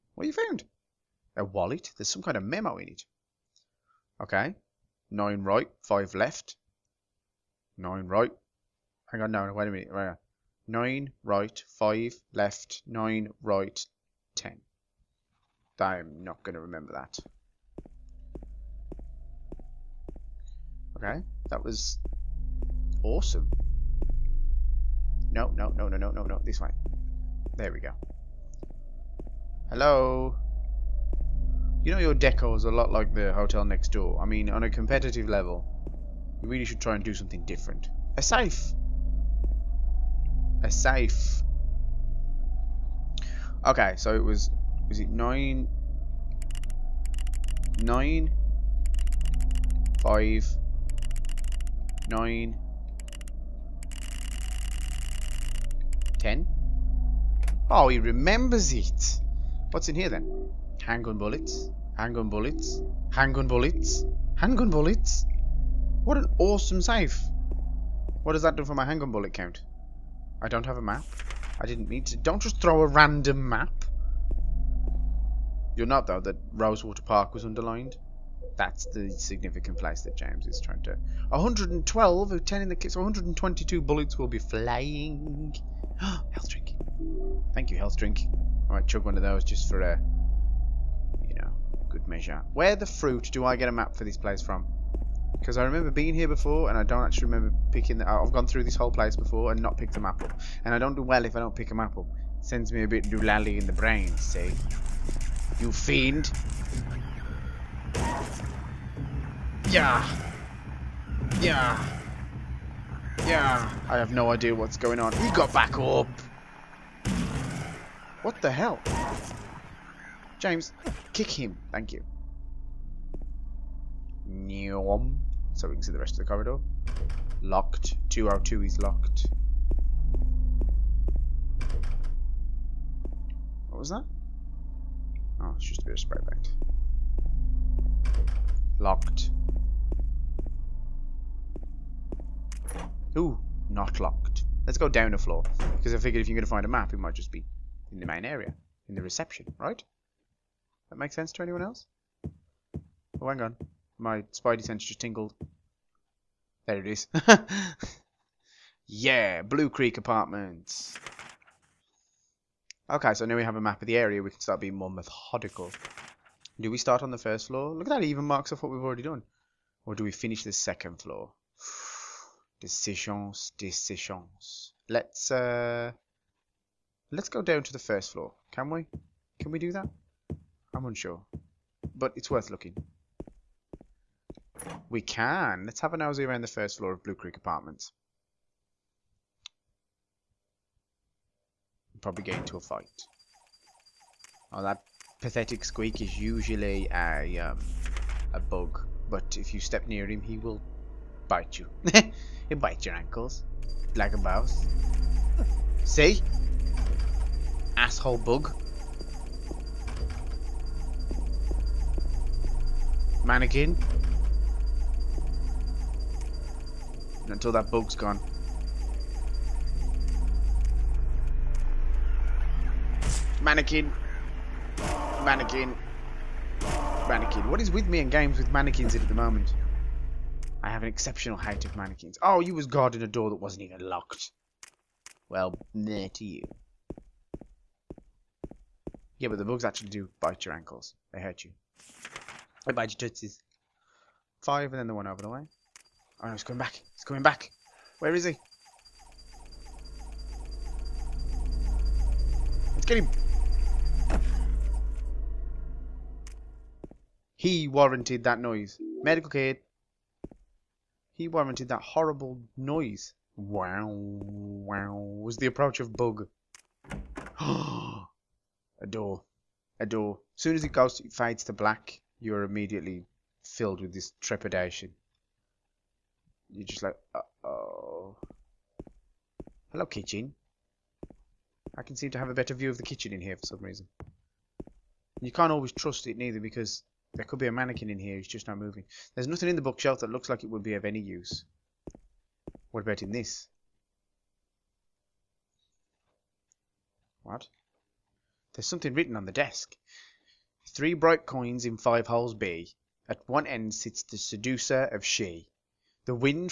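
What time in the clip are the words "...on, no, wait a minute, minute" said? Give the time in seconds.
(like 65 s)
9 s.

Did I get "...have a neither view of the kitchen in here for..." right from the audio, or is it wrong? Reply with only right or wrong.
wrong.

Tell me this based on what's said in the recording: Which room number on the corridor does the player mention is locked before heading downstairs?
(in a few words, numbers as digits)
202.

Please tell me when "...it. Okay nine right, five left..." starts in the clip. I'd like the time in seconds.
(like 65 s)
2 s.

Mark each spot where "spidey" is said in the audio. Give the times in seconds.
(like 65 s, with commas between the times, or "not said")
154 s.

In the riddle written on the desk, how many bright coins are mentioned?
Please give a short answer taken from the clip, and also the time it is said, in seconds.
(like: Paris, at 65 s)
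3, at 300 s.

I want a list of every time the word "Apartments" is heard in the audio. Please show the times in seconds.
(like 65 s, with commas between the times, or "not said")
159 s, 187 s.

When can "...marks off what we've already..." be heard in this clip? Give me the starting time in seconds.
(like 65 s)
168 s.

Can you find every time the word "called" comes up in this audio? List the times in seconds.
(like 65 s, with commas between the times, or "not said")
not said.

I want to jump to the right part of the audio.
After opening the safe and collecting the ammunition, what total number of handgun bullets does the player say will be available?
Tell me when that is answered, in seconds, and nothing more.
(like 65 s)
82 s.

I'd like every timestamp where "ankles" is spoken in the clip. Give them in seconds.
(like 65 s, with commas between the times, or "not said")
202 s, 240 s.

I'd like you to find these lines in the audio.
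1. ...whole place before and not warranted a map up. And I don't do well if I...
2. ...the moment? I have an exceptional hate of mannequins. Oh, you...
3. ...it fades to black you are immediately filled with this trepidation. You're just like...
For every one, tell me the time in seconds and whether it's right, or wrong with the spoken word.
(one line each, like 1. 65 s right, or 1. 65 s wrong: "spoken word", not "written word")
1. 98 s wrong: "picked", not "warranted"
2. 229 s right
3. 270 s right.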